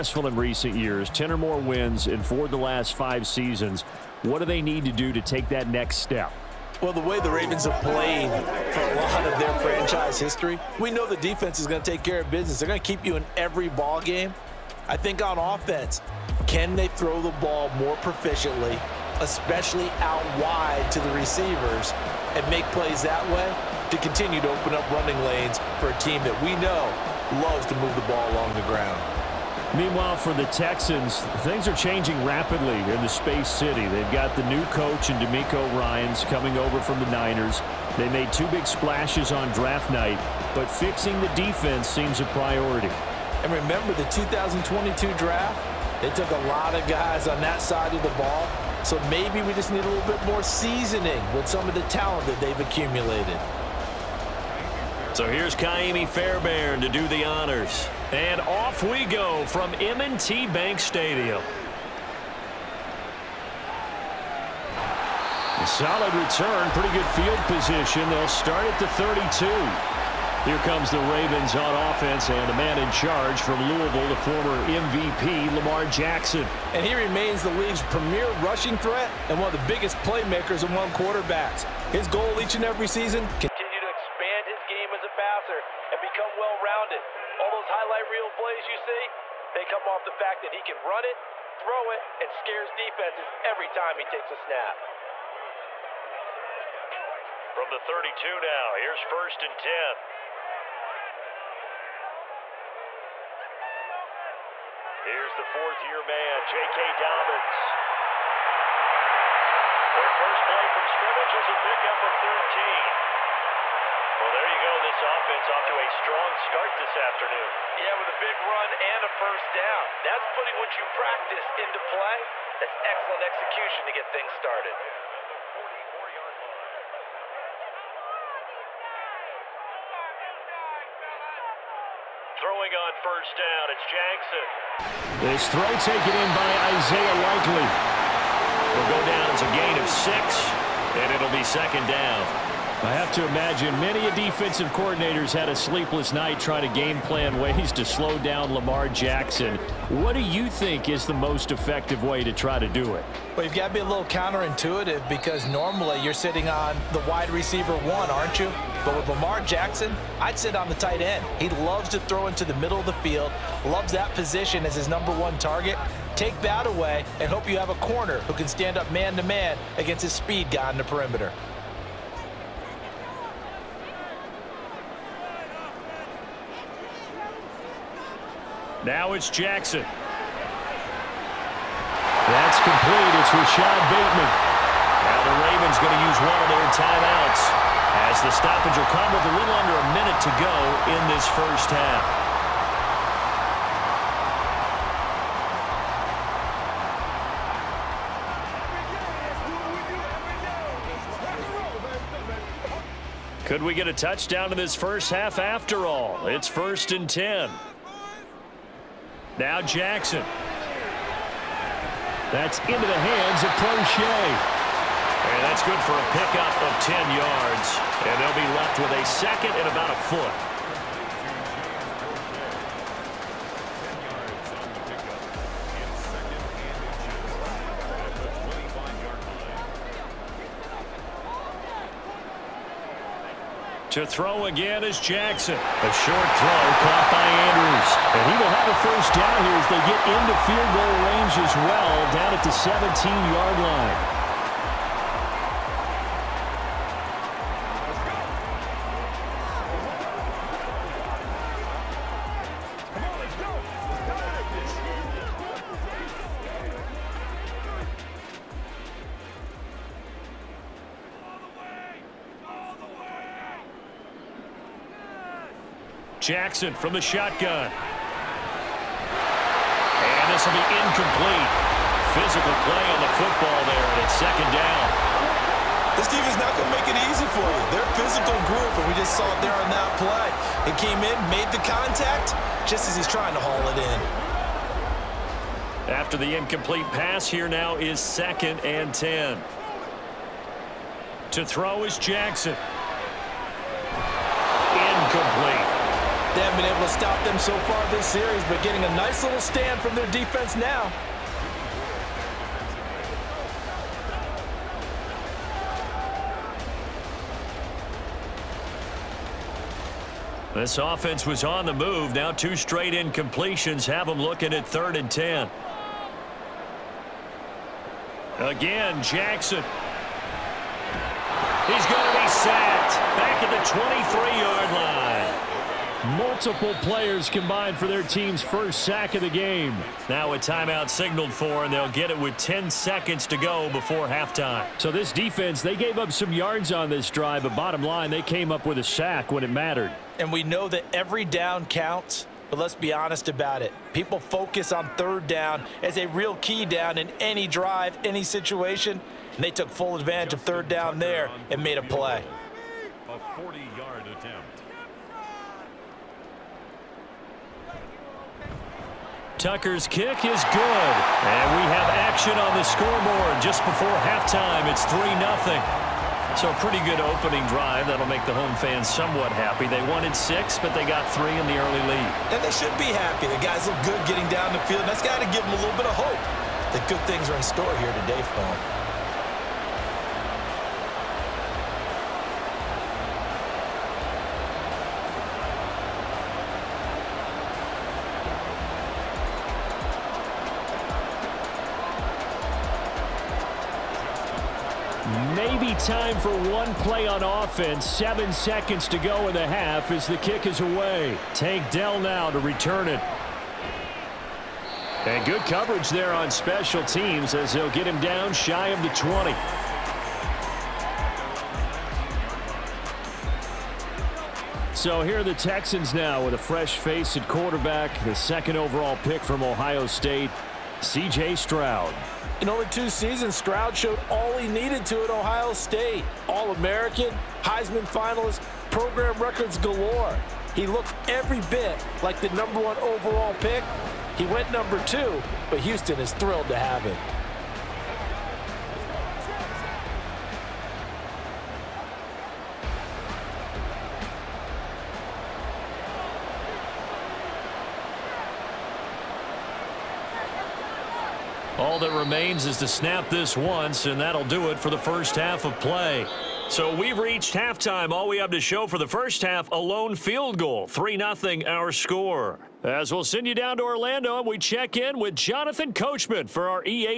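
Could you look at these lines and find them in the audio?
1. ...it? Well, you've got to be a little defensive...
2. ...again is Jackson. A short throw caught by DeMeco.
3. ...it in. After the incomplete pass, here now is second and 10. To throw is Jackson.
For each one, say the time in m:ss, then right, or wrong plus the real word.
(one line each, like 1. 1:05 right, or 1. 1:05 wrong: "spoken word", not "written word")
1. 2:32 wrong: "counterintuitive", not "defensive"
2. 3:54 wrong: "Andrews", not "DeMeco"
3. 4:43 right.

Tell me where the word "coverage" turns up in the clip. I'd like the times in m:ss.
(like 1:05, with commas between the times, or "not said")
6:45.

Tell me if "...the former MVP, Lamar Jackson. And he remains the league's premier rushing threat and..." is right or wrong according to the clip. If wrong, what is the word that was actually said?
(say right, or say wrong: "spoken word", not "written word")
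right.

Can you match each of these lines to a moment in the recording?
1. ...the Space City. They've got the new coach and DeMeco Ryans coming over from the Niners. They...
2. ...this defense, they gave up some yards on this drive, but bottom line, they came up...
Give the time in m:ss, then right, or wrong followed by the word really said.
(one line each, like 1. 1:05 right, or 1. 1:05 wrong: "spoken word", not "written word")
1. 0:33 right
2. 5:34 right.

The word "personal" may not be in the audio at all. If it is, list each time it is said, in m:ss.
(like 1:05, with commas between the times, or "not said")
not said.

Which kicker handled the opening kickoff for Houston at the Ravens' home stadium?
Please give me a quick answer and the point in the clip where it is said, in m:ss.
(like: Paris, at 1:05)
Kaimi Fairbairn, at 0:55.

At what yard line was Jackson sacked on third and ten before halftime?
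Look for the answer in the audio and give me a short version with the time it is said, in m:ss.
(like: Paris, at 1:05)
23, at 5:24.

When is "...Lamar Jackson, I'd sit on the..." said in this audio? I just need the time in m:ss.
2:39.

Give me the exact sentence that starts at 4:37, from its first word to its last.
They're physical group, and we just saw it there on that play.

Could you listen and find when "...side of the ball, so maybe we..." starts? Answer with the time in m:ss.
0:47.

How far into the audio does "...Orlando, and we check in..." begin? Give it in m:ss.
7:43.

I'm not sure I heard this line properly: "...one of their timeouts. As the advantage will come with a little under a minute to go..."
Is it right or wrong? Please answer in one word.
wrong.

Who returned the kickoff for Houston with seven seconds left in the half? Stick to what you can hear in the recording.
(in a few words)
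Tank Dell.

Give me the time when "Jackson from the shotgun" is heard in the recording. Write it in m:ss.
4:26.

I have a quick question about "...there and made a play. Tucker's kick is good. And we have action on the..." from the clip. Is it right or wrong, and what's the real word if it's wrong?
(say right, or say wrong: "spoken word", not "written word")
right.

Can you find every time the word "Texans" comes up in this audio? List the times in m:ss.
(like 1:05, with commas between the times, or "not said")
0:30, 6:55.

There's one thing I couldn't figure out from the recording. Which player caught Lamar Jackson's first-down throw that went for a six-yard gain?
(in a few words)
Isaiah Likely.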